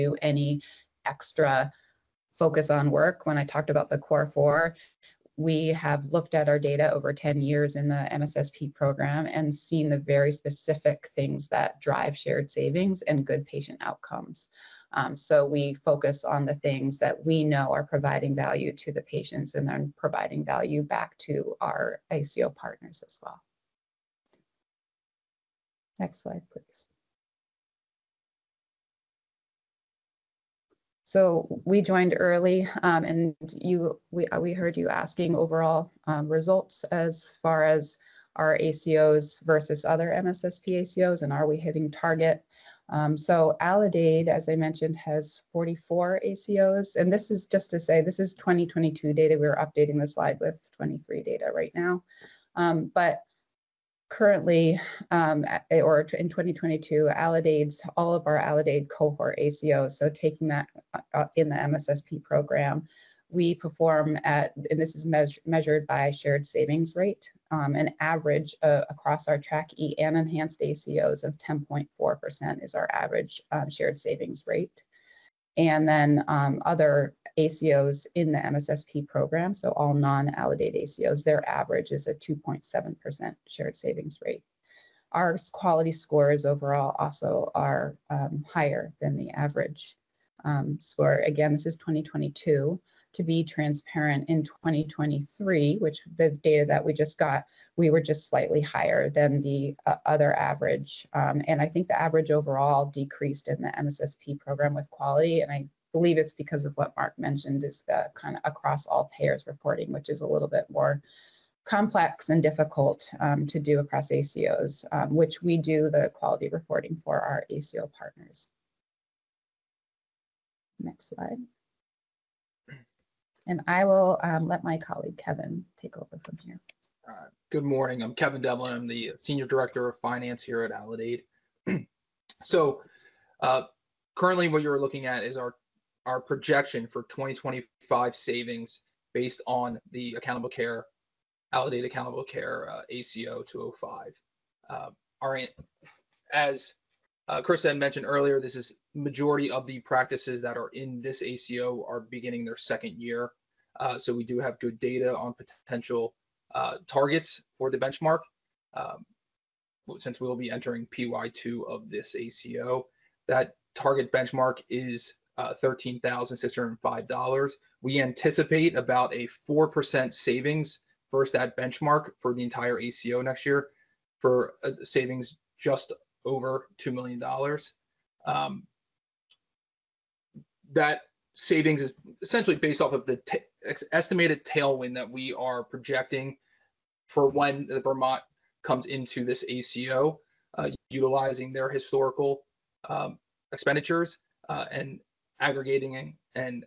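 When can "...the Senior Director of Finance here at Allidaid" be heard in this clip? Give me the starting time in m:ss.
2:08.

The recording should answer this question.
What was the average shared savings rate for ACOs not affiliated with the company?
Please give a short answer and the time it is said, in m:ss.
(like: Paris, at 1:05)
2.7%, at 1:22.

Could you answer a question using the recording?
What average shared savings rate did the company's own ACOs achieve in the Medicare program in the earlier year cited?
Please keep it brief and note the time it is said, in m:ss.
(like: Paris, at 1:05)
10.4%, at 1:11.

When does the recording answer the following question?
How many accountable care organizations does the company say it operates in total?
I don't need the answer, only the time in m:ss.
0:45.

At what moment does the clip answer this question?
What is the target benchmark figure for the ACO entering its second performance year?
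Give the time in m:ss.
2:45.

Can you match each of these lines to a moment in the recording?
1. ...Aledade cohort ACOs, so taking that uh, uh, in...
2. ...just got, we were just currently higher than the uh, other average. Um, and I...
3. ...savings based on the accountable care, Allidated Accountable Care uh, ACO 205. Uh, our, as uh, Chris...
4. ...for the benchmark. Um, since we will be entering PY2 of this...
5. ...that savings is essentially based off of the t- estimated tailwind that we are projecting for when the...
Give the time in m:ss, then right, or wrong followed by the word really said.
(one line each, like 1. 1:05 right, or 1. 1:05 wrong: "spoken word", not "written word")
1. 0:58 right
2. 1:36 wrong: "slightly", not "currently"
3. 2:18 right
4. 2:37 right
5. 3:00 right.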